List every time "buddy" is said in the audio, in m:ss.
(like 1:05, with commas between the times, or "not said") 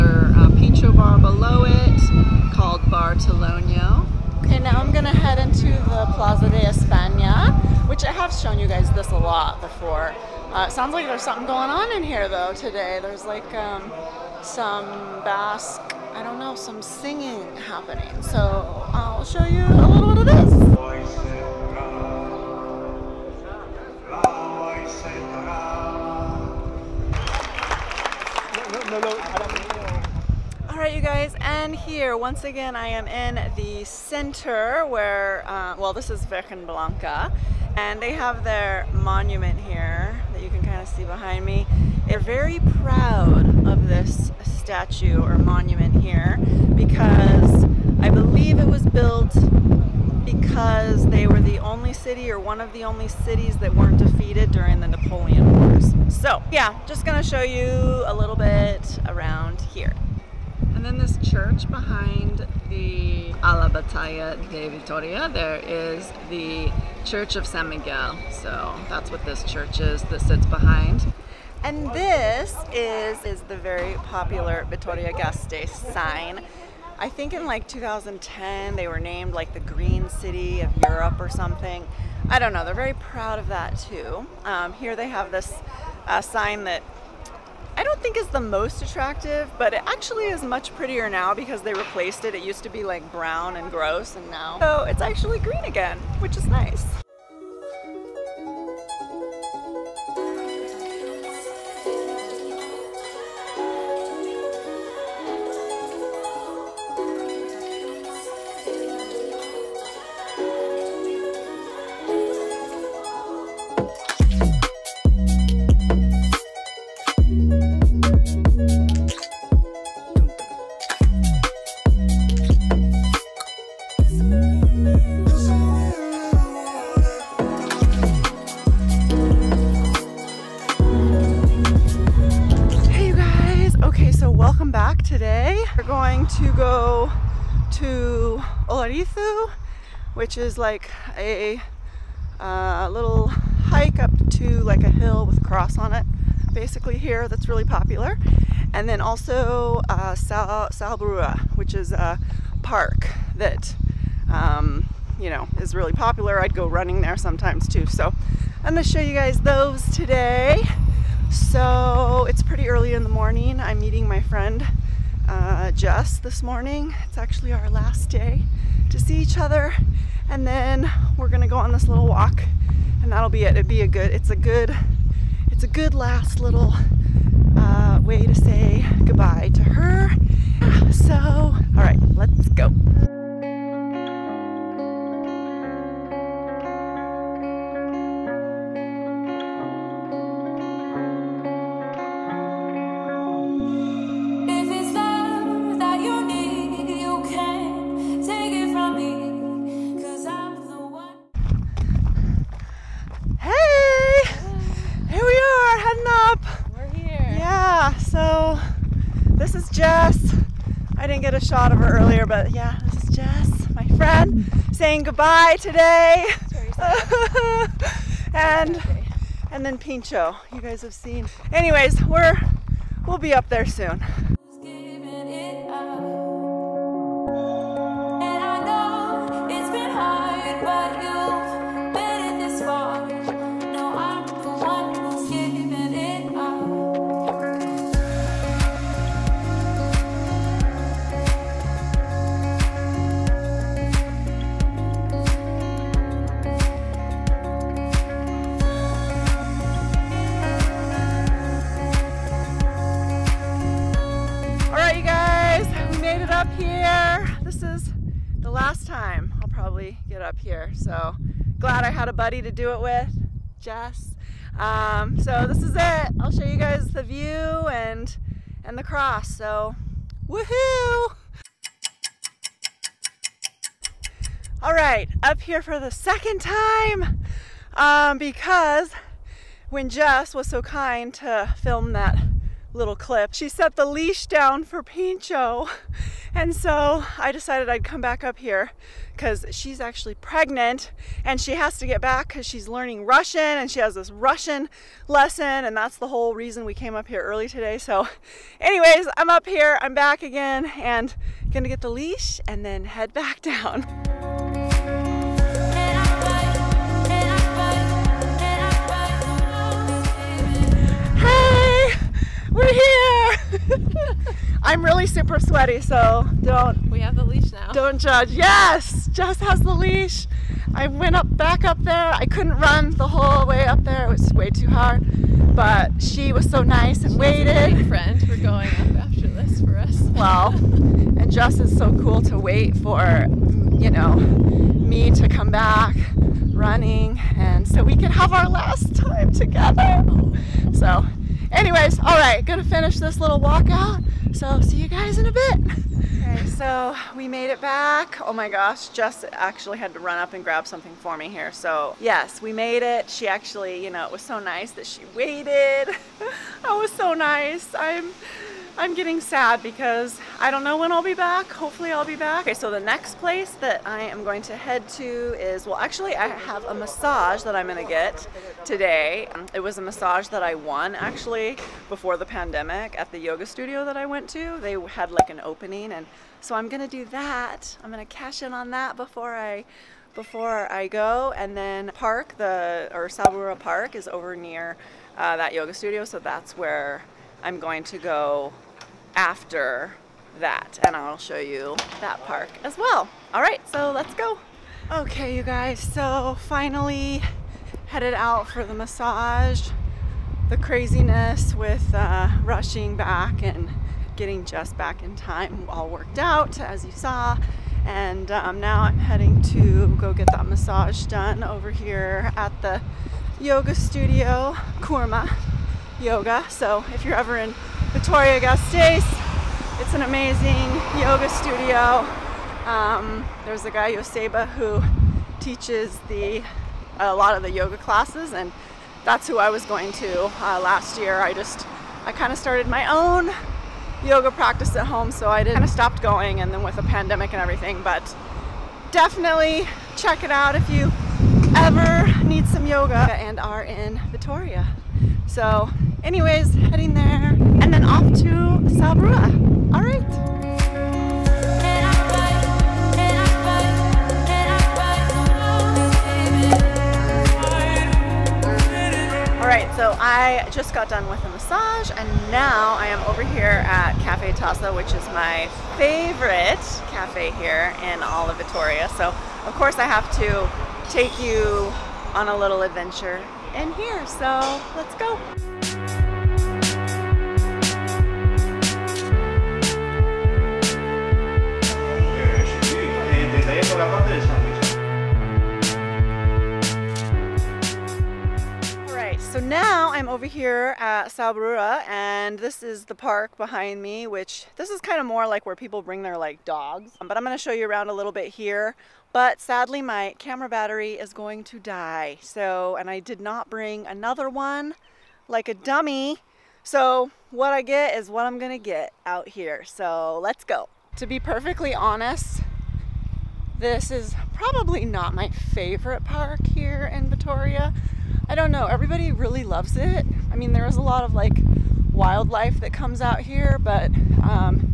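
4:22.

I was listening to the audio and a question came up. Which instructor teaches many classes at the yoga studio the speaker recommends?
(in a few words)
Joseba.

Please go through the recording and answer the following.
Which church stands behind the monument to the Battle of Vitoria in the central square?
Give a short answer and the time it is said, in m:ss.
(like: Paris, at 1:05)
Church of San Miguel, at 1:07.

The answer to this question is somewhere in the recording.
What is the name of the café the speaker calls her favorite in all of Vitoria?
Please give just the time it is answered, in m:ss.
7:43.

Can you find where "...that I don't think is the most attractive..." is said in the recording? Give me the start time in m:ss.
1:26.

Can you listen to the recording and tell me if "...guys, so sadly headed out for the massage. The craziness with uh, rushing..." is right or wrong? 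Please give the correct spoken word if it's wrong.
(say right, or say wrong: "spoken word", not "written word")
wrong: "finally", not "sadly".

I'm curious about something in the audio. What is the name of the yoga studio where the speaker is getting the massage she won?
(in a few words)
Kurma Yoga.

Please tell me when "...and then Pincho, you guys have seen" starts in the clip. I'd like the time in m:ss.
3:39.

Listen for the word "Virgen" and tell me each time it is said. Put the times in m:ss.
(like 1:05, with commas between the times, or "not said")
0:36.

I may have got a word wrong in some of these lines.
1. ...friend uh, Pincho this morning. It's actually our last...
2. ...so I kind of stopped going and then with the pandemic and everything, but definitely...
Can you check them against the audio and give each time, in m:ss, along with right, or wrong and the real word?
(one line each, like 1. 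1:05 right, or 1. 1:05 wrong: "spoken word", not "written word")
1. 2:44 wrong: "Jess", not "Pincho"
2. 7:15 right.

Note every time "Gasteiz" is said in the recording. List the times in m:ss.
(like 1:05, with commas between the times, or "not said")
1:15, 6:58.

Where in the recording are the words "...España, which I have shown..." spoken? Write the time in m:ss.
0:06.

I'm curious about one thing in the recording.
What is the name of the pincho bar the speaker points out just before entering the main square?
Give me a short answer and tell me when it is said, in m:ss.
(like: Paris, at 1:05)
Bar Toloño, at 0:02.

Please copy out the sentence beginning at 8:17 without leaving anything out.
But I'm going to show you around a little bit here.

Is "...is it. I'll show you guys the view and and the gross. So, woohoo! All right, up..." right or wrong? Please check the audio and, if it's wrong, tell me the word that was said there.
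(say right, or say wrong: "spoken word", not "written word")
wrong: "cross", not "gross".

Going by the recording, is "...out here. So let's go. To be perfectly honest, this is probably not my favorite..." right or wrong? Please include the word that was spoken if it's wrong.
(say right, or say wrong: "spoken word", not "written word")
right.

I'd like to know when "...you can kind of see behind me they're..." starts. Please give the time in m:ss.
0:40.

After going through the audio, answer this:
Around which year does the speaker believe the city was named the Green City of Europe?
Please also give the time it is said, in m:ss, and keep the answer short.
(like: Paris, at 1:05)
2010, at 1:17.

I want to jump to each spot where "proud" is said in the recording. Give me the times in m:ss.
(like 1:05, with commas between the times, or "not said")
0:42, 1:22.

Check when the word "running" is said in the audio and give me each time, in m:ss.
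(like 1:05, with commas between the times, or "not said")
2:36, 5:36.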